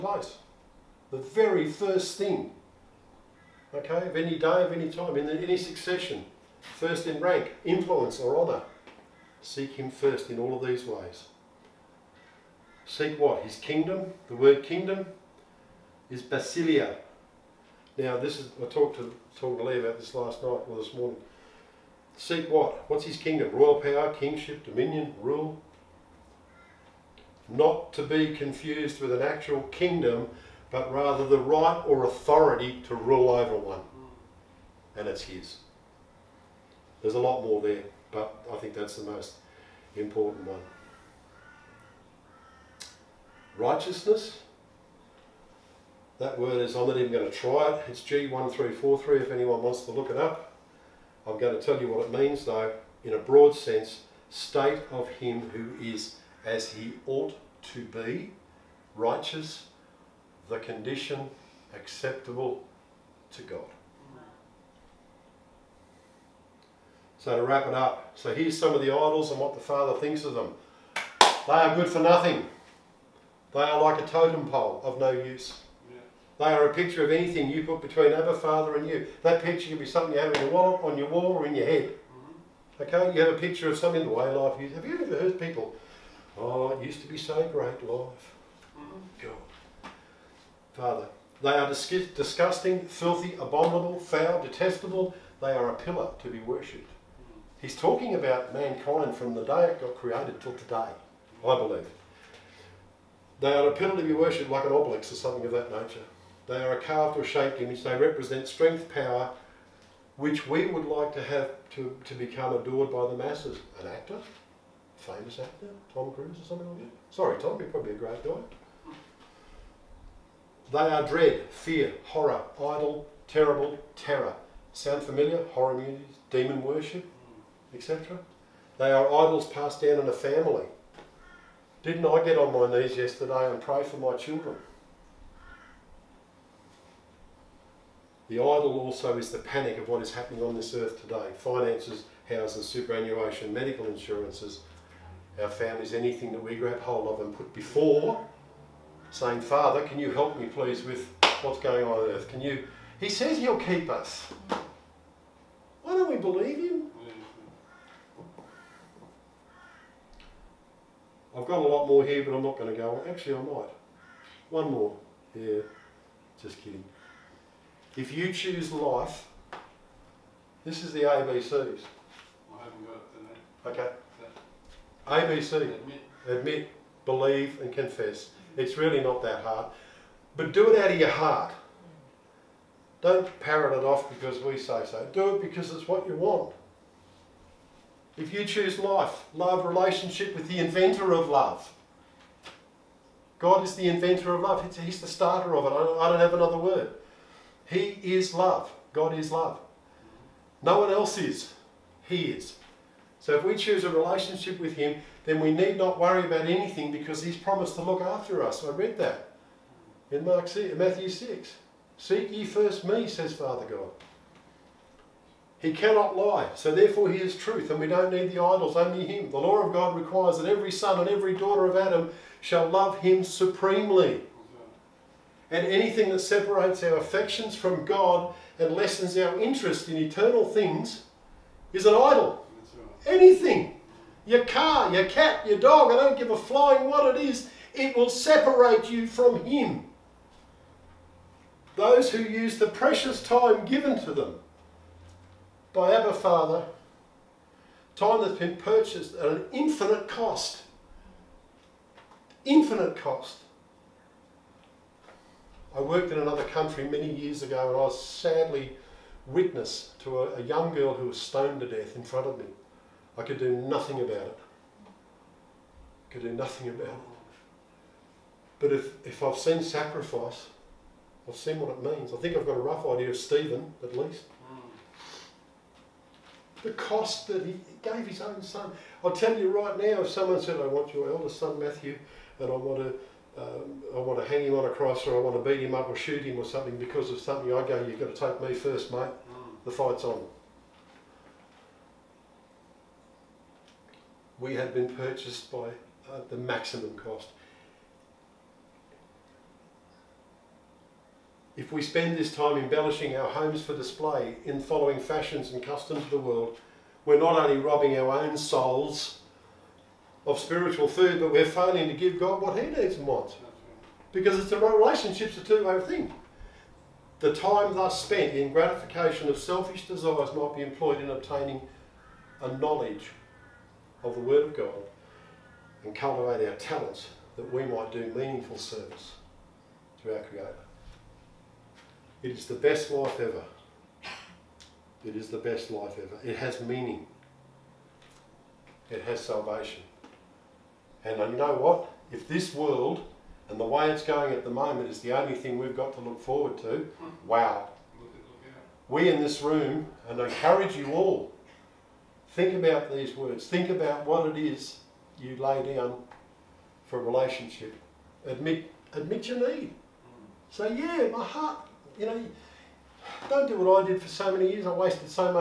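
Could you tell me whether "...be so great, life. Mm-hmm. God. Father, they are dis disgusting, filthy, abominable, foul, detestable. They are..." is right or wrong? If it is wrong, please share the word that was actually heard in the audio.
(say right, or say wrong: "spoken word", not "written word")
right.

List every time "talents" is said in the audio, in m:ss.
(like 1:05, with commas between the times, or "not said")
5:26.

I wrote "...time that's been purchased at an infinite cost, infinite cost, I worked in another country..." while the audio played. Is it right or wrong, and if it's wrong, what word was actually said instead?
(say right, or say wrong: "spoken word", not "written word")
right.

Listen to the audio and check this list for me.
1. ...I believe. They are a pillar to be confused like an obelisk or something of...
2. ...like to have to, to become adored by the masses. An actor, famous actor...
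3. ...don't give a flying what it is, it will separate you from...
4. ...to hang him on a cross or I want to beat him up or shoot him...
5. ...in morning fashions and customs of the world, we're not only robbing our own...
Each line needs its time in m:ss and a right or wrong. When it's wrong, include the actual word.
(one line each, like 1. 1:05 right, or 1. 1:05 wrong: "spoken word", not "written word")
1. 1:41 wrong: "worshipped", not "confused"
2. 1:50 right
3. 3:55 right
4. 4:44 right
5. 5:04 wrong: "following", not "morning".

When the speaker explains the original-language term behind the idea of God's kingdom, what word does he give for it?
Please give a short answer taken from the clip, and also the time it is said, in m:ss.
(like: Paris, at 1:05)
basilia, at 0:16.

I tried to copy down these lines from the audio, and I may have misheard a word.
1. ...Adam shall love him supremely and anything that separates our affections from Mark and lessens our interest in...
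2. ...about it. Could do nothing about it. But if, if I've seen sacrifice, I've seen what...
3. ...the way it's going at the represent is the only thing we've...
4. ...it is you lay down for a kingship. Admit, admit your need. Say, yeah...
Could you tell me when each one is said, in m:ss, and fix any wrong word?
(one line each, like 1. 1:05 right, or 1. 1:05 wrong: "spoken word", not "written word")
1. 3:41 wrong: "God", not "Mark"
2. 4:23 right
3. 5:43 wrong: "moment", not "represent"
4. 5:54 wrong: "relationship", not "kingship".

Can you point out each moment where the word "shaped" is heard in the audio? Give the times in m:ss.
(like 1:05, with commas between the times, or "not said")
1:47.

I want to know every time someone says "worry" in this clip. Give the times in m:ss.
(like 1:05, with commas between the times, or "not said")
3:25.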